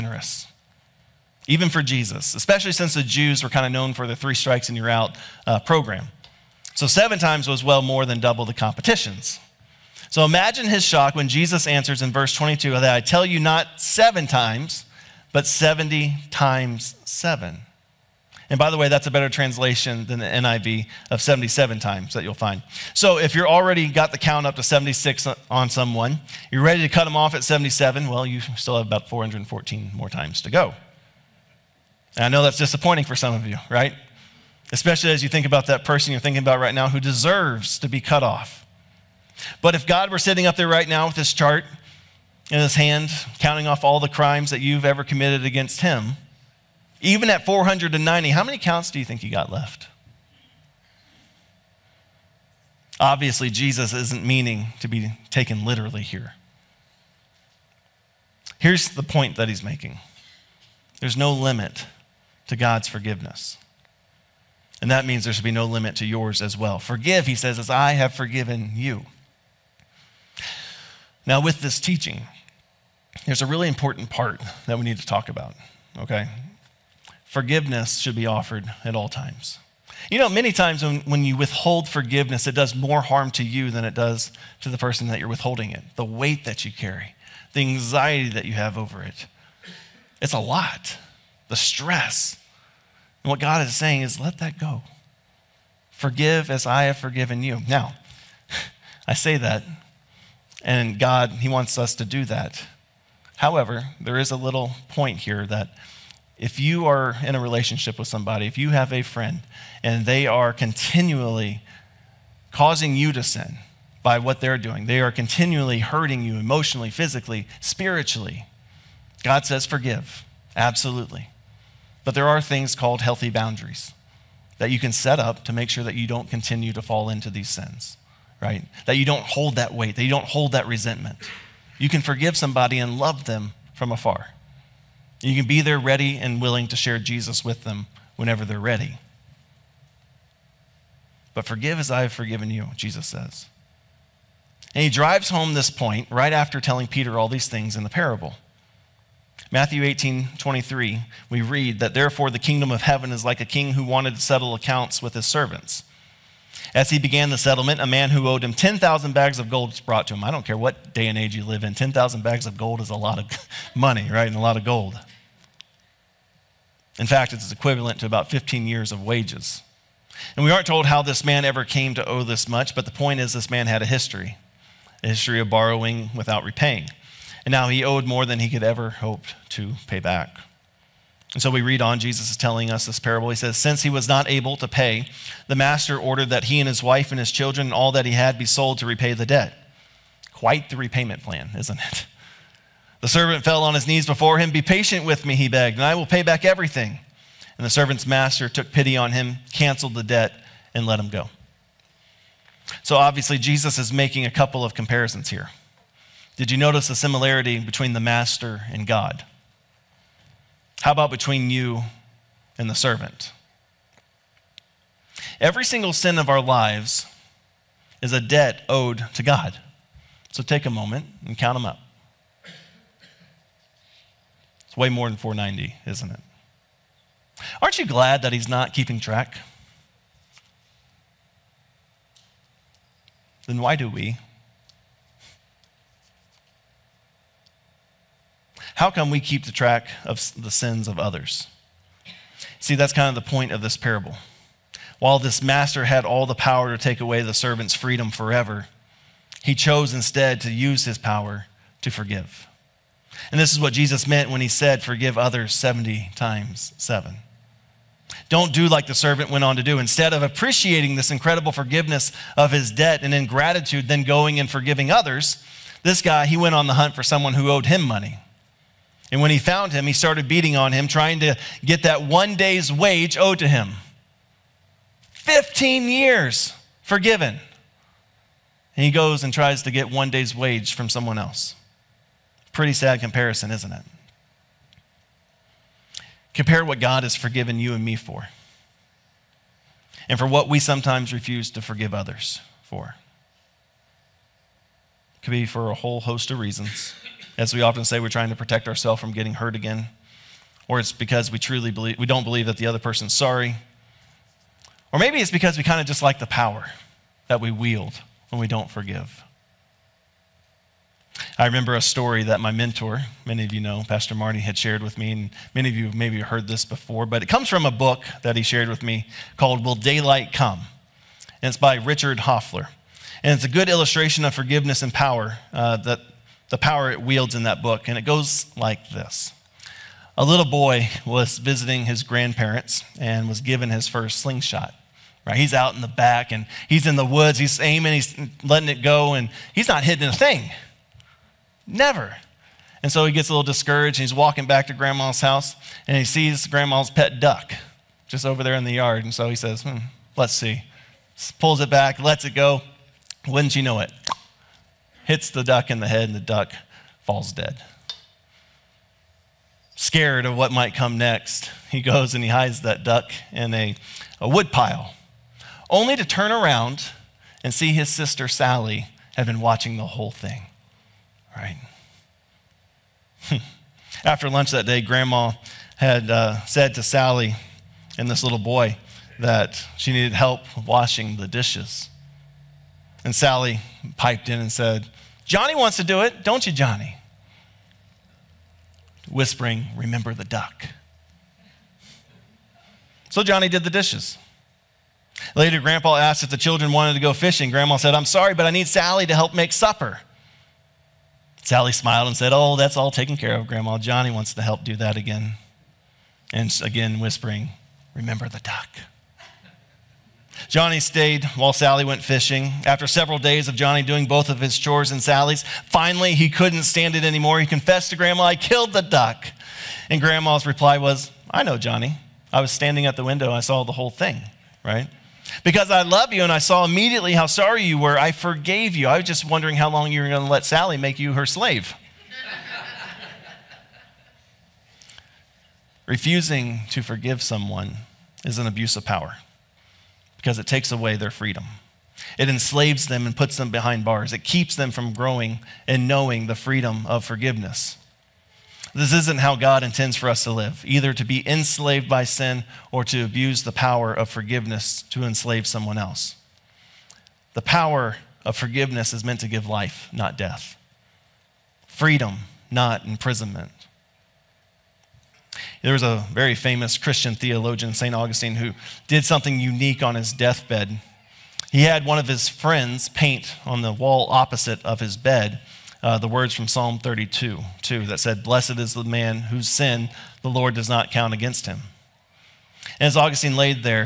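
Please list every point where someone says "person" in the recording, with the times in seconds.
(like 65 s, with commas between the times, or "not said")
35 s, 84 s, 302 s.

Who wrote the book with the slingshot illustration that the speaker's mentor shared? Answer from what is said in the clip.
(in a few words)
Richard Hoefler.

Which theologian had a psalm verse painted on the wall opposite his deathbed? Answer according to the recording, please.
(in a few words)
St. Augustine.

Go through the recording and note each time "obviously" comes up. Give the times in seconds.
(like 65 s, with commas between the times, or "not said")
52 s, 202 s.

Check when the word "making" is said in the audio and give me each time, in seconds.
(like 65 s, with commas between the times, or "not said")
59 s, 203 s.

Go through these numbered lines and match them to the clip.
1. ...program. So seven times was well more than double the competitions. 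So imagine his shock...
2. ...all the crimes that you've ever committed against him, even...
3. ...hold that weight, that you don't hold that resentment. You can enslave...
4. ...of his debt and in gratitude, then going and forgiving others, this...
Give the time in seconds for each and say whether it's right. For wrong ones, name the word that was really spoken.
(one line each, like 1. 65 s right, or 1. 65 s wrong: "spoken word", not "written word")
1. 5 s right
2. 43 s right
3. 129 s wrong: "forgive", not "enslave"
4. 262 s right.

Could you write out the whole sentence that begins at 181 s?
And so we read on, Jesus is telling us this parable.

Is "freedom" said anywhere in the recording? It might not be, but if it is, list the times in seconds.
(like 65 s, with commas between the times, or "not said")
247 s, 441 s, 446 s, 461 s.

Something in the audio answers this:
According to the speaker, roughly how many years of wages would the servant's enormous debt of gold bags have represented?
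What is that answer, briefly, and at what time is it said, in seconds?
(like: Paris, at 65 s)
15 years, at 168 s.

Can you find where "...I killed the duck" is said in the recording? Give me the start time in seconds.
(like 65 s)
418 s.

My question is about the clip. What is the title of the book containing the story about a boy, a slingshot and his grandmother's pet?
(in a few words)
Will Daylight Come?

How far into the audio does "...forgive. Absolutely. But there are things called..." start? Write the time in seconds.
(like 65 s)
119 s.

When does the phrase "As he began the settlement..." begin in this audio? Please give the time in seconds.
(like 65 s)
156 s.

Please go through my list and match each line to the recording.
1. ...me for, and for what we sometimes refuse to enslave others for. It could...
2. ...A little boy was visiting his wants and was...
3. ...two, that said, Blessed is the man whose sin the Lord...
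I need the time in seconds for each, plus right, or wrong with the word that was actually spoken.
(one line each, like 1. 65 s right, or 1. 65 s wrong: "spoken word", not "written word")
1. 287 s wrong: "forgive", not "enslave"
2. 330 s wrong: "grandparents", not "wants"
3. 477 s right.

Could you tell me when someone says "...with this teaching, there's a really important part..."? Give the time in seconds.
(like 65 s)
71 s.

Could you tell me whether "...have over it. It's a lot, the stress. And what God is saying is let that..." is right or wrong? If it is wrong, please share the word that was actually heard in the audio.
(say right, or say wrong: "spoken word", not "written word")
right.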